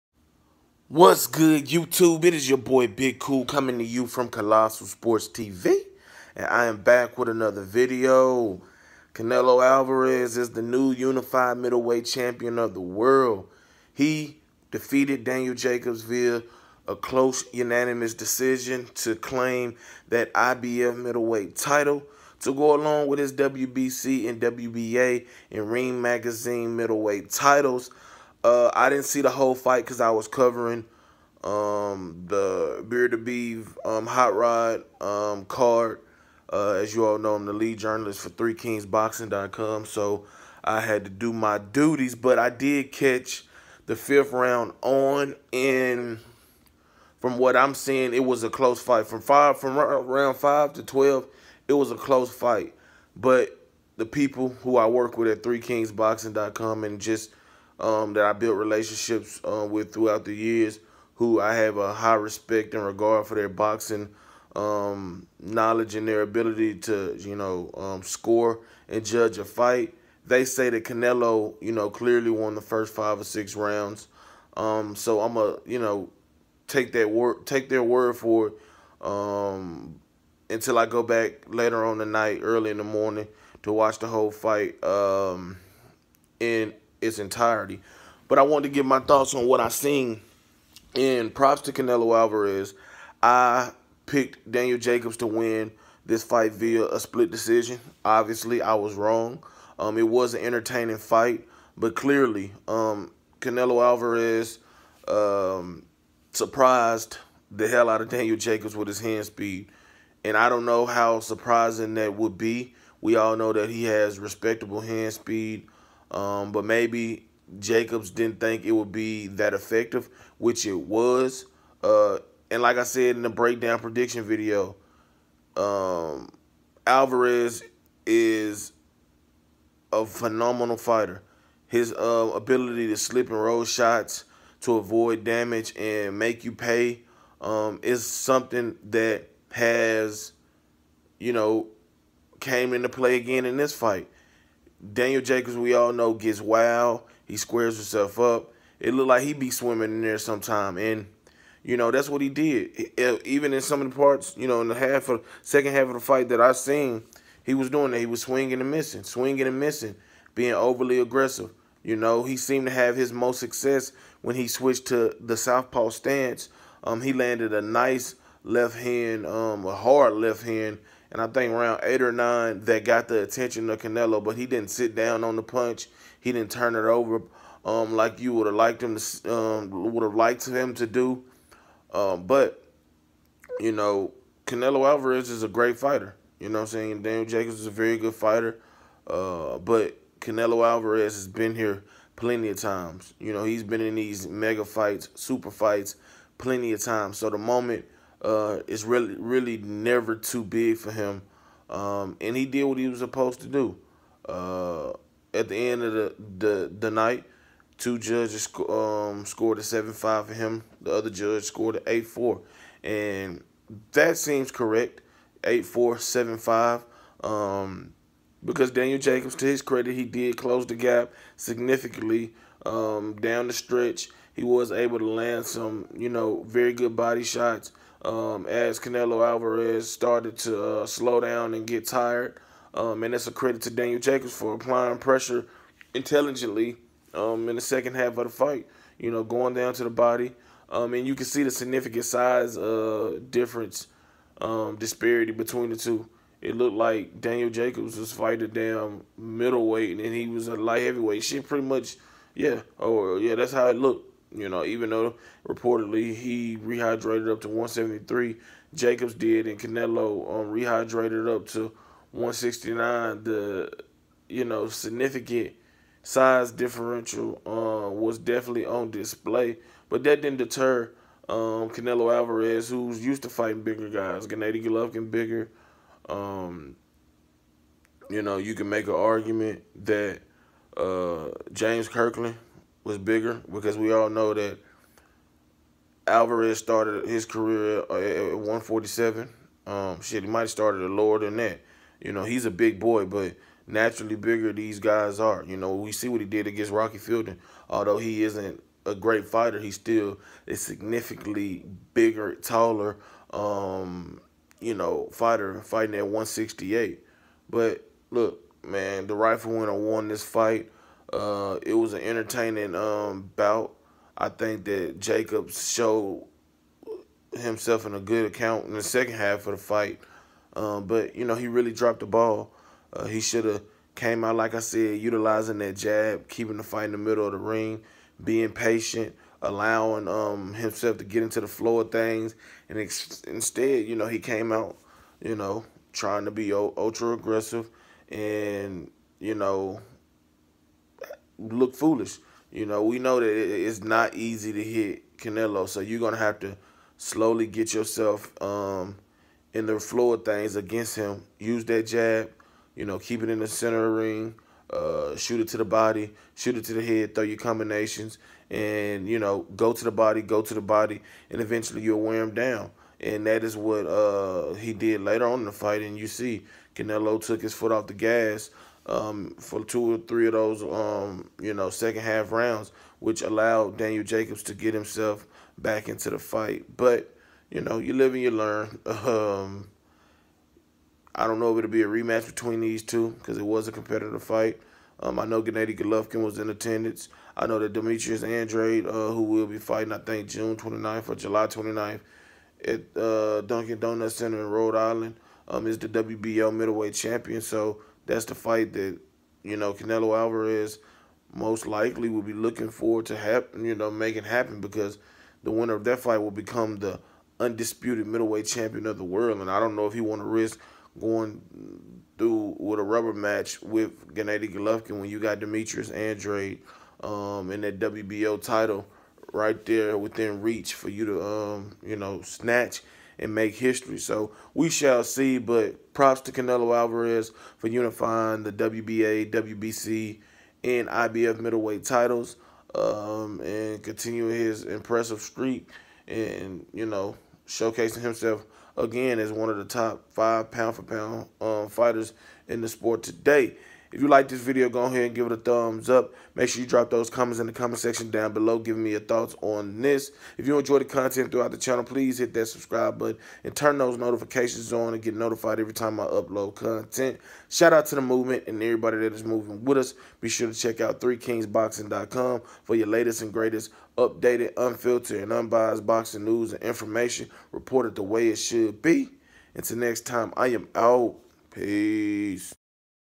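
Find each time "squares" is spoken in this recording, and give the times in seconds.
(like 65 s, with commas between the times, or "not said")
147 s.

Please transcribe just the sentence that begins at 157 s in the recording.
He was swinging and missing, swinging and missing, being overly aggressive.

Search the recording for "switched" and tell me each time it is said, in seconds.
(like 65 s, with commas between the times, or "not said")
164 s.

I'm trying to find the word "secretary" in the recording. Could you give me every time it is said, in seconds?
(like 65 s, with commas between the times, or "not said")
not said.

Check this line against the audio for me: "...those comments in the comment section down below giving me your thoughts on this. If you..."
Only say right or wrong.
right.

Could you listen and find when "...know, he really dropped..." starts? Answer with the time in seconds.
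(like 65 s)
321 s.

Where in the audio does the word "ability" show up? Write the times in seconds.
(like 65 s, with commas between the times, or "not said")
66 s, 132 s.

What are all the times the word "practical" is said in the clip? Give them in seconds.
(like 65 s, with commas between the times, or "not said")
not said.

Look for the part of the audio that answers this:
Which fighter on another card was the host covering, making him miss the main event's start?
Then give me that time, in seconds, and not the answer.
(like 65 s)
32 s.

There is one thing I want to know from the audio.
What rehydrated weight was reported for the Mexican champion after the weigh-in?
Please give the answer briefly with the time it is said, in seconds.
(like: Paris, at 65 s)
169, at 262 s.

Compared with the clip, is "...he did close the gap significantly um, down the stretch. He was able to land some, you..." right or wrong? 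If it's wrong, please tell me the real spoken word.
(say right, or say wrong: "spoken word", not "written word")
right.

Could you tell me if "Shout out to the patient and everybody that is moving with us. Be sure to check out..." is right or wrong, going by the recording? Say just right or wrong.
wrong.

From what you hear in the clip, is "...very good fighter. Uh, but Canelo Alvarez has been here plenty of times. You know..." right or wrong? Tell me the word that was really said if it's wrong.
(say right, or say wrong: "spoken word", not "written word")
right.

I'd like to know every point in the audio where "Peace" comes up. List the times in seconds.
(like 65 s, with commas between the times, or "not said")
471 s.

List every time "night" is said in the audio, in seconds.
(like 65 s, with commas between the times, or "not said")
82 s, 206 s.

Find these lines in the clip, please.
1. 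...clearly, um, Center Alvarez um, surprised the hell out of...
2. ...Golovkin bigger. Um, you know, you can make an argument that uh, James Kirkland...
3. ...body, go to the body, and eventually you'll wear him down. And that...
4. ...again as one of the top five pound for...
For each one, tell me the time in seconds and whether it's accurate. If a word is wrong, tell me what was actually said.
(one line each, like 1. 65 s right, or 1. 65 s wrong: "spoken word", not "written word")
1. 101 s wrong: "Canelo", not "Center"
2. 274 s right
3. 359 s right
4. 438 s right.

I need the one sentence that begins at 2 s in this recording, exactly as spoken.
It is your boy Big Cool coming to you from Colossal Sports TV.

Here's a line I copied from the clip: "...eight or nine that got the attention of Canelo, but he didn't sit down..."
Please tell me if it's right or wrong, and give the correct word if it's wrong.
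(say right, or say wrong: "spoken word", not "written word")
right.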